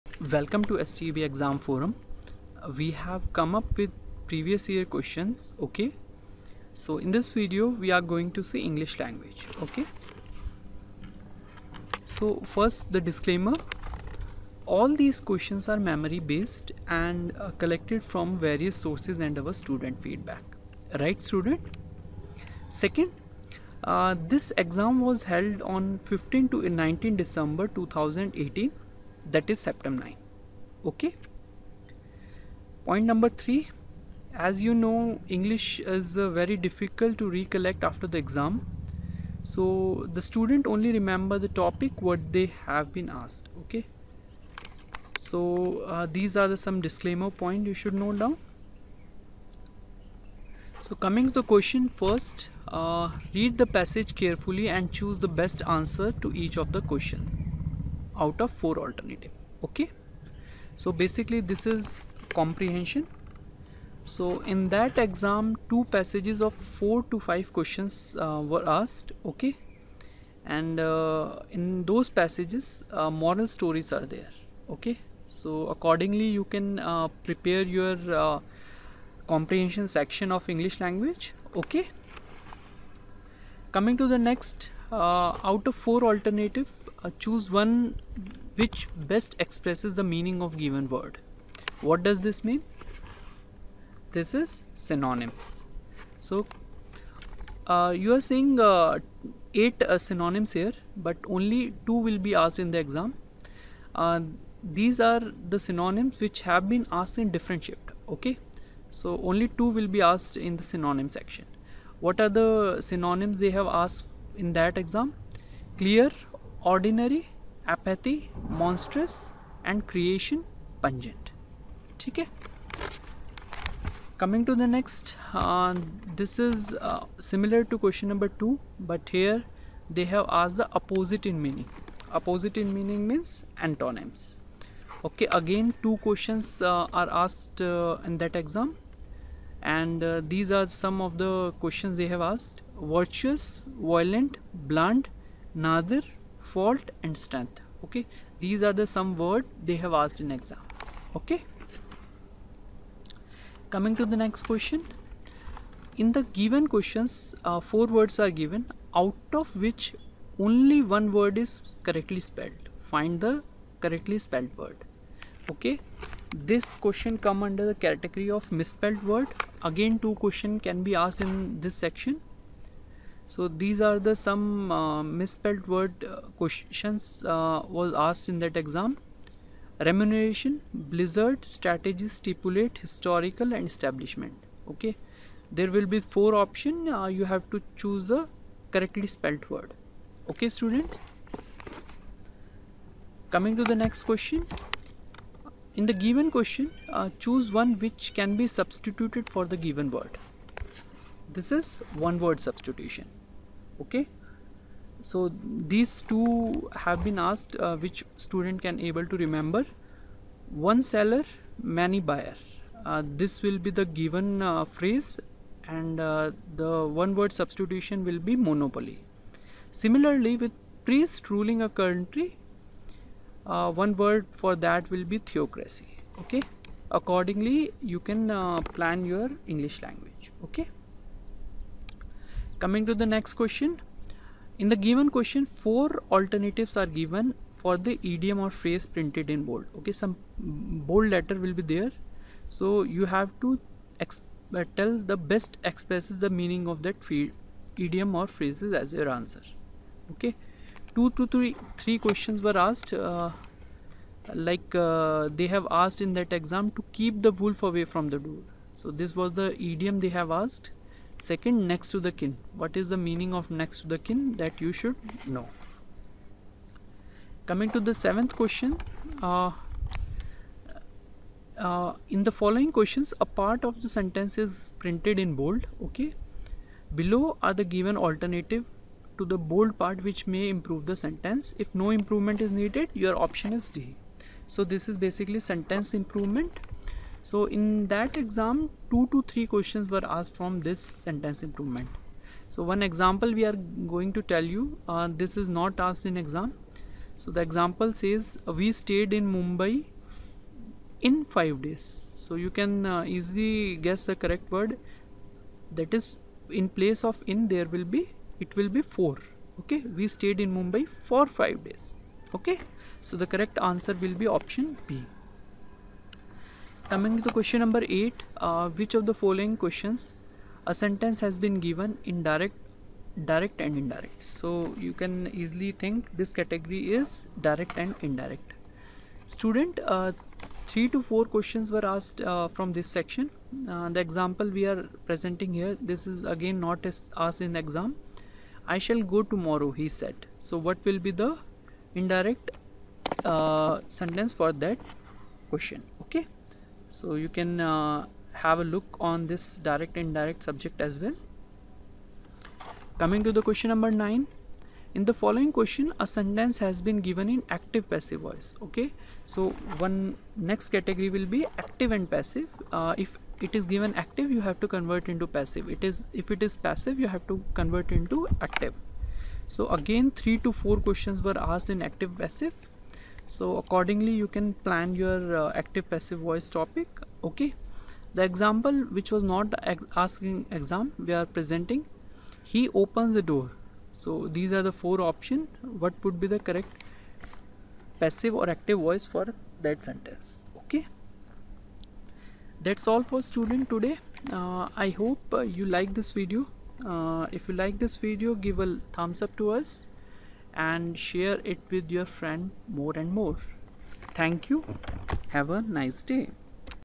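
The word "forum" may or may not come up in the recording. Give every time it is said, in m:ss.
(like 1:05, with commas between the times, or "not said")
0:01.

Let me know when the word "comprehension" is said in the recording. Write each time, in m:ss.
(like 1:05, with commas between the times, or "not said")
1:02, 1:19.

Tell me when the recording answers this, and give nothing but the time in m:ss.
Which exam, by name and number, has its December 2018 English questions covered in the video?
0:29.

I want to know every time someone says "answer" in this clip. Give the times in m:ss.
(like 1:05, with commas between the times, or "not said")
0:55, 4:09, 5:13.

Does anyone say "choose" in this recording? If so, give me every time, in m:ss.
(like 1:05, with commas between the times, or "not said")
0:54, 1:27, 3:07, 3:17.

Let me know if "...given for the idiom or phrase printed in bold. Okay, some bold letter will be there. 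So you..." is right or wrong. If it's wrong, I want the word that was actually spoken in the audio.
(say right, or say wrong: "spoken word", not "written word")
right.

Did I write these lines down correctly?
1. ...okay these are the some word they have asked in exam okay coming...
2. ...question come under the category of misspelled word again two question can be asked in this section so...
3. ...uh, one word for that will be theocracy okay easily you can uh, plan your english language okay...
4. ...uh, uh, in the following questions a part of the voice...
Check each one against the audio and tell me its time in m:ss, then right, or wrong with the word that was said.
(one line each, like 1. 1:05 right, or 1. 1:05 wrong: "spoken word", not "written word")
1. 2:27 right
2. 2:46 right
3. 3:42 wrong: "accordingly", not "easily"
4. 4:29 wrong: "sentence", not "voice".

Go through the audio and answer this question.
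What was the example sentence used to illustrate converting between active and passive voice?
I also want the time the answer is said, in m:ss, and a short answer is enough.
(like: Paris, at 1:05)
He opens the door, at 6:22.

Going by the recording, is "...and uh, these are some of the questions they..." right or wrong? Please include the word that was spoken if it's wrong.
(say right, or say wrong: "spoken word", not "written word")
right.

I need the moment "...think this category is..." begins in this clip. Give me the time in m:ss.
5:25.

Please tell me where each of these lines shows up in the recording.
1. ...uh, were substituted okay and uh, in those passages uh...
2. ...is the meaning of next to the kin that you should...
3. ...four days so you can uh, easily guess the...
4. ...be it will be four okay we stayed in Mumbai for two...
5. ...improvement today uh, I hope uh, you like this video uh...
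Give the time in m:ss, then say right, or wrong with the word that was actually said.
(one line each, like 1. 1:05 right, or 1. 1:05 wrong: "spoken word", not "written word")
1. 1:08 wrong: "asked", not "substituted"
2. 4:22 right
3. 5:01 wrong: "five", not "four"
4. 5:07 wrong: "five", not "two"
5. 6:33 wrong: "student", not "improvement".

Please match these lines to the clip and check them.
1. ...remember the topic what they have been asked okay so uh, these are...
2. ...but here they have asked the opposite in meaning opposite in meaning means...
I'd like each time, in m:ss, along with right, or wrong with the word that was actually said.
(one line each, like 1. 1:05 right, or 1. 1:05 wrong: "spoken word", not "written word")
1. 0:40 right
2. 2:08 right.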